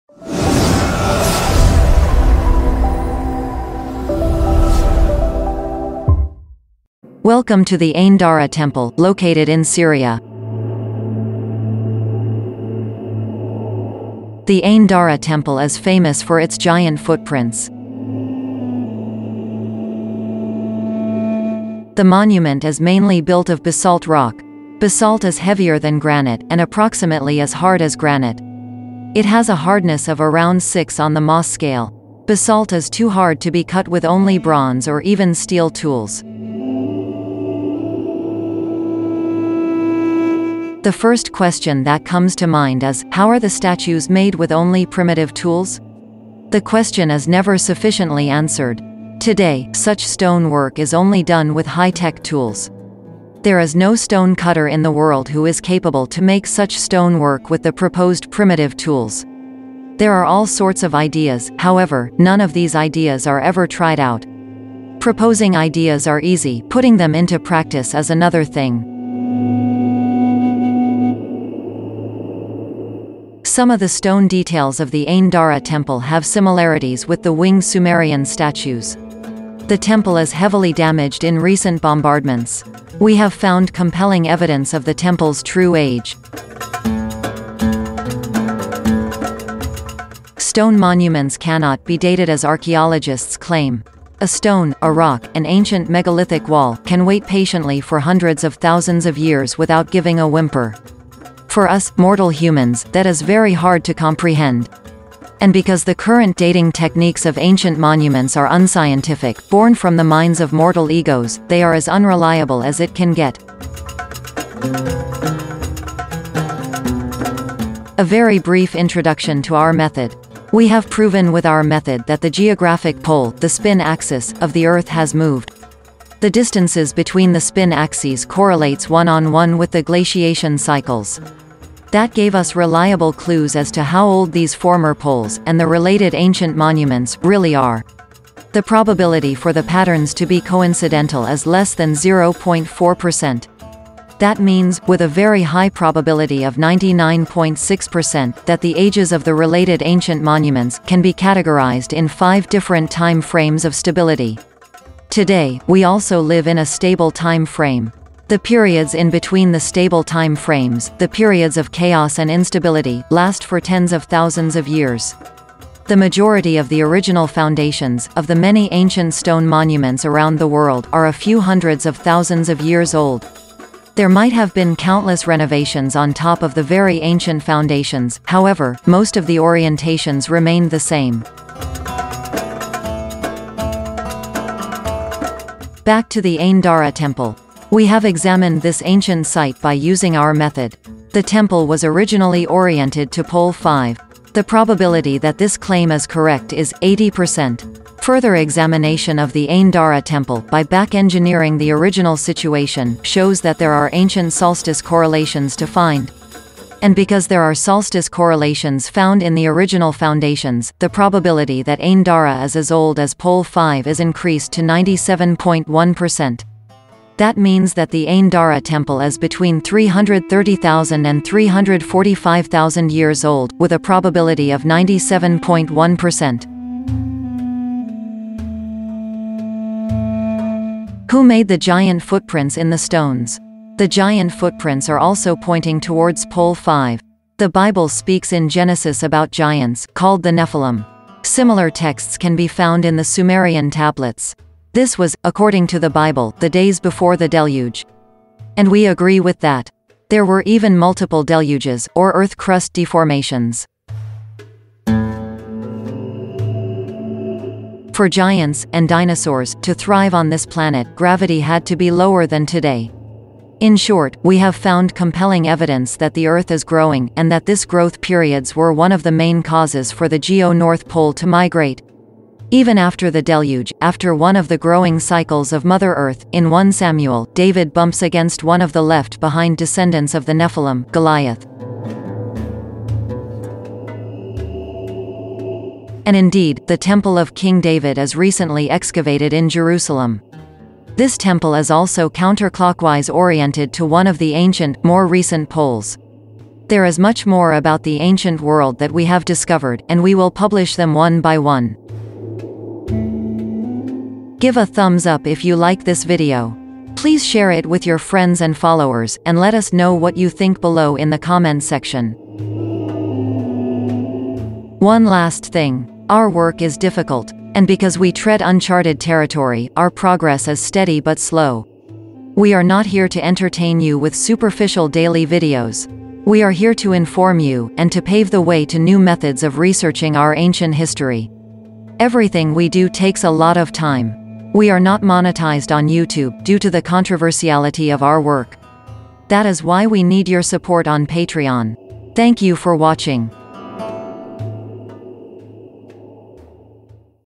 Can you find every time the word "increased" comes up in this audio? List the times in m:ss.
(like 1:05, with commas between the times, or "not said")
3:33.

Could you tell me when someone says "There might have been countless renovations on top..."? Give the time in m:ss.
2:53.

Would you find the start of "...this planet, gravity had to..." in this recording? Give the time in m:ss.
4:20.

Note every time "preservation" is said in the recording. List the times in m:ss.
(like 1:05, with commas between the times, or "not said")
not said.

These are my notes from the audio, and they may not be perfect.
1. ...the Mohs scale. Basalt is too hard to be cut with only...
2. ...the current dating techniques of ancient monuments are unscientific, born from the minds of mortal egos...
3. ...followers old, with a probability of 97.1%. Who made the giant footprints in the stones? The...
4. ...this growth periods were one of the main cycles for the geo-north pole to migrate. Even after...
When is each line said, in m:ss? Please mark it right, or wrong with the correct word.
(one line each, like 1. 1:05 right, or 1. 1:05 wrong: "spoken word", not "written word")
1. 0:31 right
2. 1:45 right
3. 3:42 wrong: "years", not "followers"
4. 4:27 wrong: "causes", not "cycles".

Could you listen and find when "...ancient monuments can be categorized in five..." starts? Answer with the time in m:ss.
2:29.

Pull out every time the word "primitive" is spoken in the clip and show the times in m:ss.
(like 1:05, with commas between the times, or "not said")
0:44, 0:58.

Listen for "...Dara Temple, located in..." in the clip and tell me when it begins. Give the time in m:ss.
0:08.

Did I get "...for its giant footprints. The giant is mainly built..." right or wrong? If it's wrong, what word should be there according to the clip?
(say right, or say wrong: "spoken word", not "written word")
wrong: "monument", not "giant".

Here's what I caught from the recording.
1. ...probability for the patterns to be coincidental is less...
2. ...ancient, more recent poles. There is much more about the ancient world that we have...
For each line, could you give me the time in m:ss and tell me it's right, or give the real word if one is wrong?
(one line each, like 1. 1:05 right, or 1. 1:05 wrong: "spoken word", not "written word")
1. 2:18 right
2. 4:54 right.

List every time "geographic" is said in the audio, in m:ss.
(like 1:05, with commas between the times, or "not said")
2:02.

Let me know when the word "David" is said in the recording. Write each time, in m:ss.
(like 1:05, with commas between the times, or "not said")
4:37, 4:47.